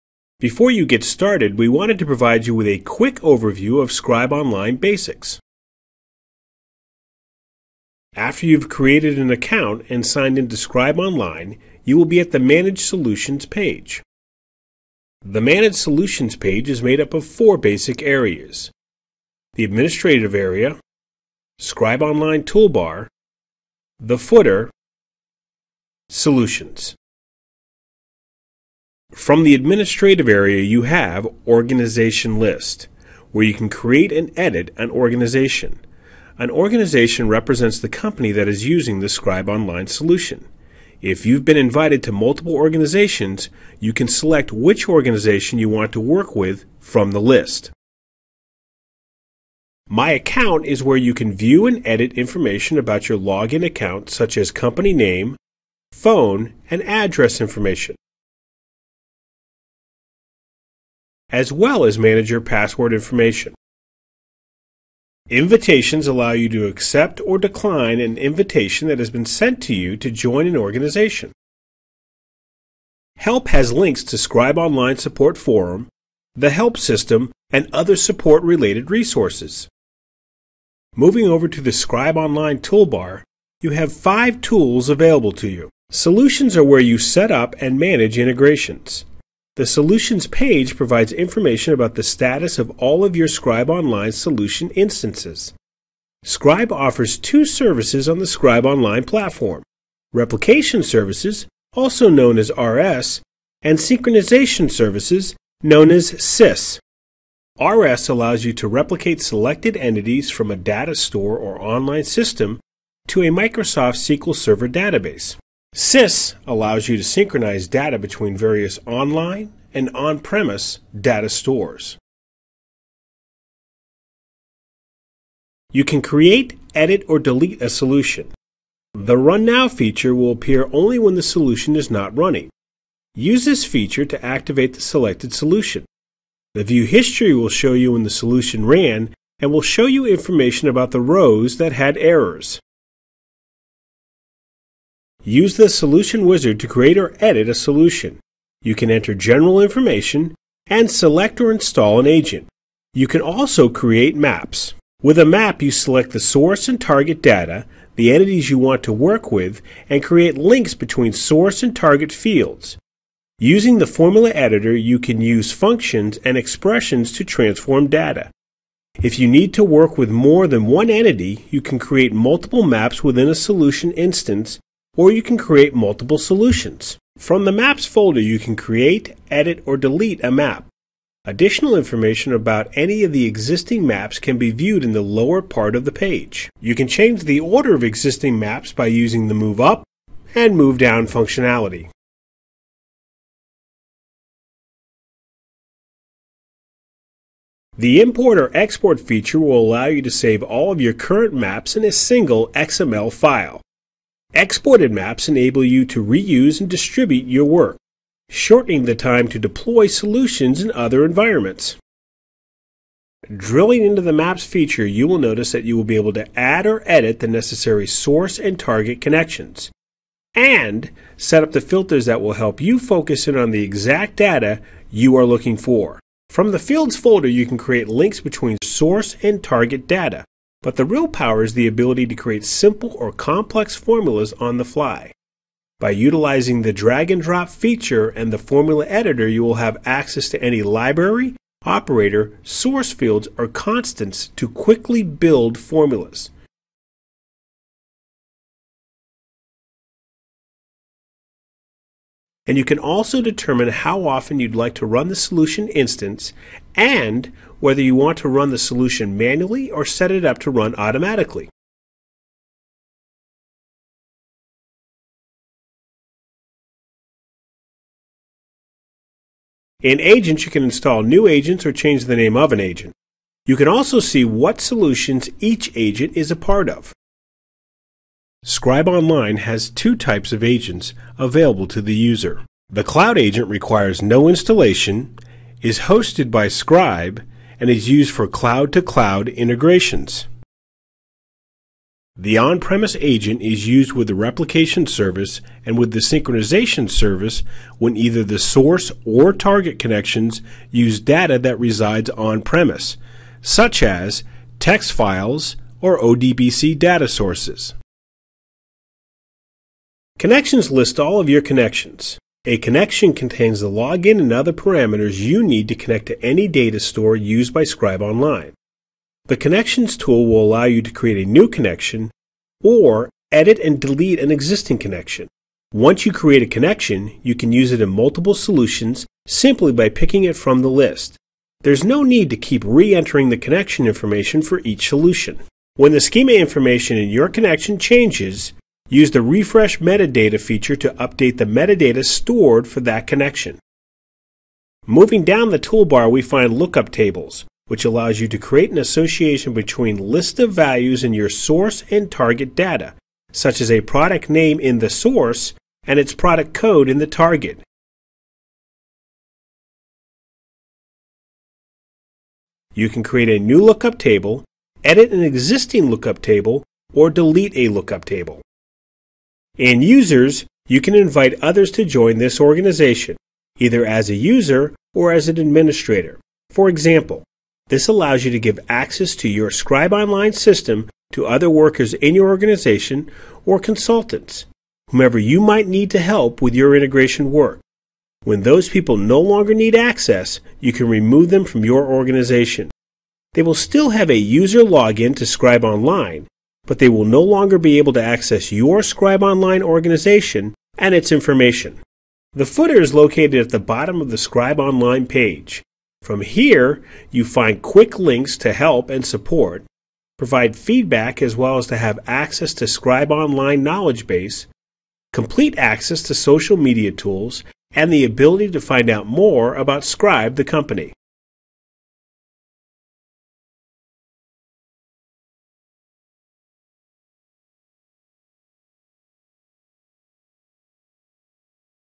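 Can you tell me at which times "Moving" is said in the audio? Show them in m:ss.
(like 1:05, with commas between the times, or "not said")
1:20, 5:44.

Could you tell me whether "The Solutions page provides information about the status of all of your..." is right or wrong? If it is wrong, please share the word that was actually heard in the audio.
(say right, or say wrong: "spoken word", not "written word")
right.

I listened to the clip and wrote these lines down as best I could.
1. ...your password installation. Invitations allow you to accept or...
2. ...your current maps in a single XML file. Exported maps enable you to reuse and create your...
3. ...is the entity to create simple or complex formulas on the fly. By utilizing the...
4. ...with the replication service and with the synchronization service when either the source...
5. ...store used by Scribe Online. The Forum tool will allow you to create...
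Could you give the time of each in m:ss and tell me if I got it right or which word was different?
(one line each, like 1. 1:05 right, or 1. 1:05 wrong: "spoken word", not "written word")
1. 1:02 wrong: "information", not "installation"
2. 3:20 wrong: "distribute", not "create"
3. 3:51 wrong: "ability", not "entity"
4. 4:53 right
5. 5:16 wrong: "Connections", not "Forum".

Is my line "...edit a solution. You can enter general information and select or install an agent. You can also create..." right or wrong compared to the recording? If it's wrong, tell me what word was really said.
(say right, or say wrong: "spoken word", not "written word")
right.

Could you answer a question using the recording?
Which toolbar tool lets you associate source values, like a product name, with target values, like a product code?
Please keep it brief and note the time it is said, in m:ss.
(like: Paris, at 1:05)
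lookup tables, at 5:46.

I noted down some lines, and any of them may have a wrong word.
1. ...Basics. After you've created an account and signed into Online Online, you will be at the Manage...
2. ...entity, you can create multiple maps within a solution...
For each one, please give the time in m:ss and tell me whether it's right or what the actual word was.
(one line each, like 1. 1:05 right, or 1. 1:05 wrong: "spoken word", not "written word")
1. 0:04 wrong: "Scribe", not "Online"
2. 2:50 right.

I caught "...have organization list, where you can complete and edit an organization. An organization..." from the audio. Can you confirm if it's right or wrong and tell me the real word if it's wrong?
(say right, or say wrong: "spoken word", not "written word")
wrong: "create", not "complete".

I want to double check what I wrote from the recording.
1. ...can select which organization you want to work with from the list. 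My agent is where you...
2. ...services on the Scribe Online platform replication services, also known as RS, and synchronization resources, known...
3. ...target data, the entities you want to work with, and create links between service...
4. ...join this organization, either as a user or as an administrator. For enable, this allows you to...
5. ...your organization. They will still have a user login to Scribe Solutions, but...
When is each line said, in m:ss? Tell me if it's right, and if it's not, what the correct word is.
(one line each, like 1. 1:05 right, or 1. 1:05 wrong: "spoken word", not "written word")
1. 0:43 wrong: "account", not "agent"
2. 1:37 wrong: "services", not "resources"
3. 2:36 wrong: "source", not "service"
4. 6:11 wrong: "example", not "enable"
5. 6:31 wrong: "Online", not "Solutions".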